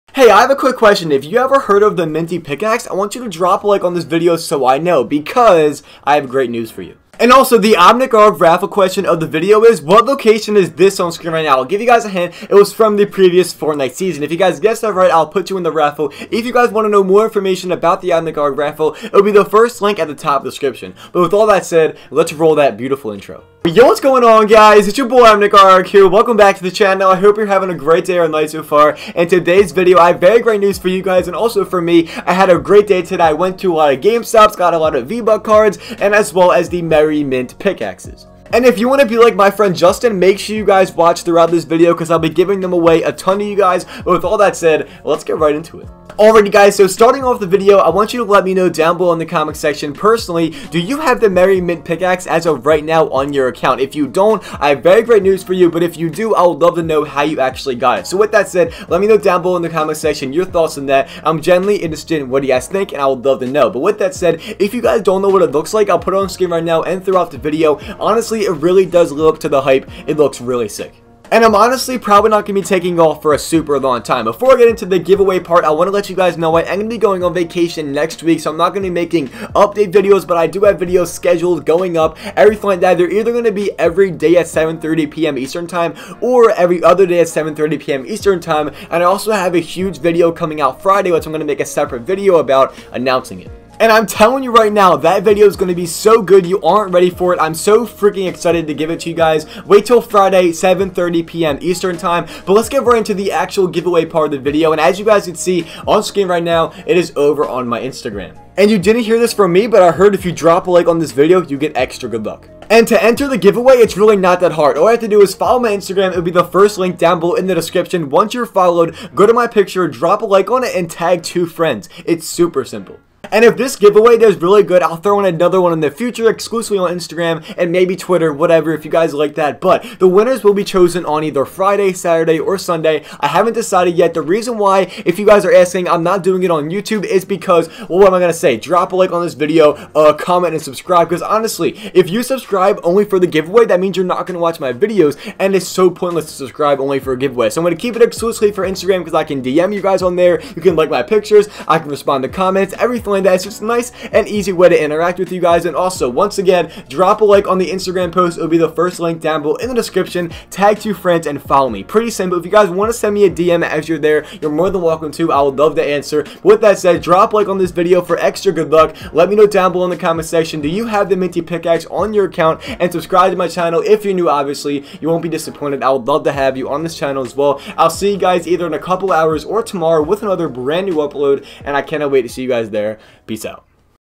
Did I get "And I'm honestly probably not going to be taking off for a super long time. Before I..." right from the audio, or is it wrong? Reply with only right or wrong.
right.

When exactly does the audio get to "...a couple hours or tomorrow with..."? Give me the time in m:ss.
2:58.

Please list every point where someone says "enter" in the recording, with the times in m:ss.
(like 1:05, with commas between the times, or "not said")
1:53.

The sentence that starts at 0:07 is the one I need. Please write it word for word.
And also, the Im NickArg raffle question of the video is, what location is this on screen right now?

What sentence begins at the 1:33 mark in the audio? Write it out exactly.
And I'm telling you right now, that video is going to be so good.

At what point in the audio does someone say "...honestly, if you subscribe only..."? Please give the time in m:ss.
2:21.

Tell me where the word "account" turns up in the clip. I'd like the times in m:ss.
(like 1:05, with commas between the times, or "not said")
0:53, 2:52.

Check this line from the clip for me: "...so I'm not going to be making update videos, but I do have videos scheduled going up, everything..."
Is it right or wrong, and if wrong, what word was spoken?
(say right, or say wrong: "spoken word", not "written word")
right.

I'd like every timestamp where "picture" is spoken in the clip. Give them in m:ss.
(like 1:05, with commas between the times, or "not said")
1:59, 2:31.